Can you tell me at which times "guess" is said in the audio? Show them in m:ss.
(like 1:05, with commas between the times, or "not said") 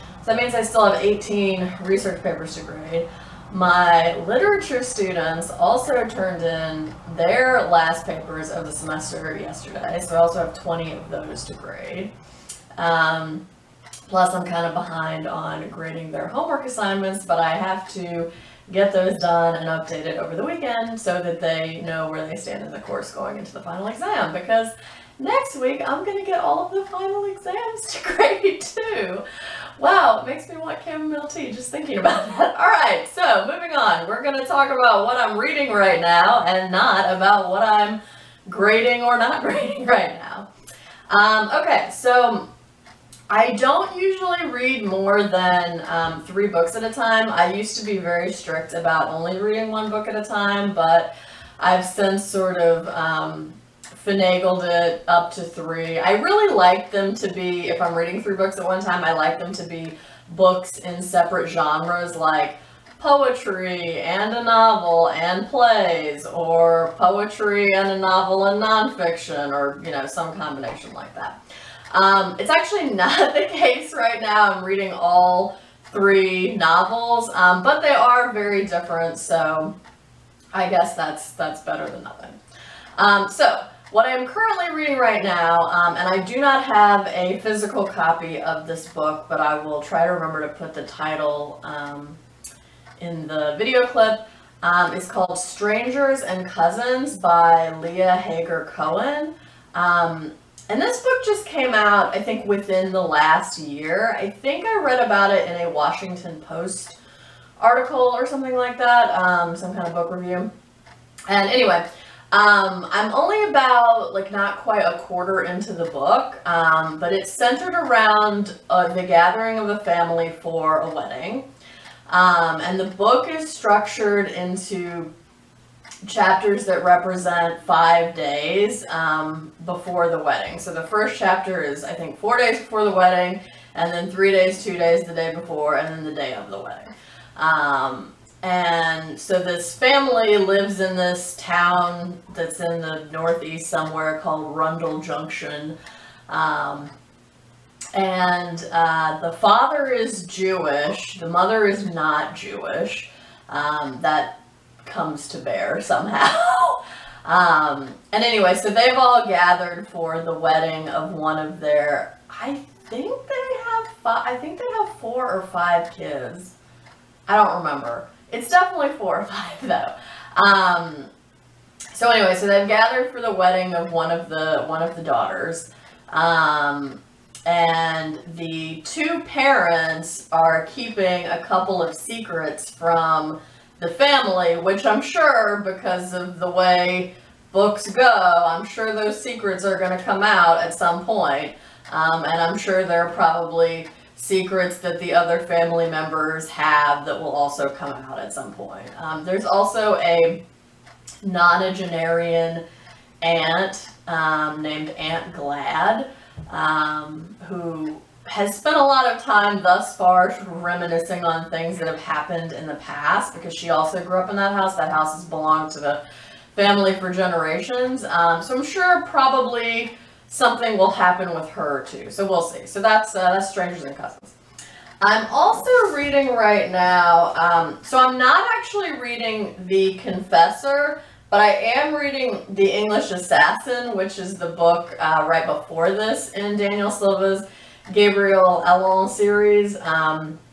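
1:20.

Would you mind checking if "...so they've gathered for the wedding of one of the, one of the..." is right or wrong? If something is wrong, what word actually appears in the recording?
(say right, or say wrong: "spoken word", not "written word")
right.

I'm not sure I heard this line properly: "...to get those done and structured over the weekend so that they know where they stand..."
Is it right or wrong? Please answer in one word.
wrong.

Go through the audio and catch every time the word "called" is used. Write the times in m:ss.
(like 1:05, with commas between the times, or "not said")
1:35, 2:24.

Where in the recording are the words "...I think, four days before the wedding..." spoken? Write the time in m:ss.
2:11.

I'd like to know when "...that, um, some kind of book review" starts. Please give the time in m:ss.
1:48.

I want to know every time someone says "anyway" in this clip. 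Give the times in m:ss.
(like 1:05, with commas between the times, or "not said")
1:51, 2:38, 2:52.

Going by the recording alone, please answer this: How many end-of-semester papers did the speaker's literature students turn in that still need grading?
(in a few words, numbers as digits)
20.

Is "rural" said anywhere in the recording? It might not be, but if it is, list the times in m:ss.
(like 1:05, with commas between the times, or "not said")
not said.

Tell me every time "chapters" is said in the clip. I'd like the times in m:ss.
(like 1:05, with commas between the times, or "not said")
2:06, 2:11.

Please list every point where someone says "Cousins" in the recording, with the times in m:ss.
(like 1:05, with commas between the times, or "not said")
1:36, 3:43.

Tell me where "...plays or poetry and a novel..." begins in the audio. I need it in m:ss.
1:05.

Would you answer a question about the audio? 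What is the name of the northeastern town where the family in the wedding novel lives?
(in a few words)
Rundle Junction.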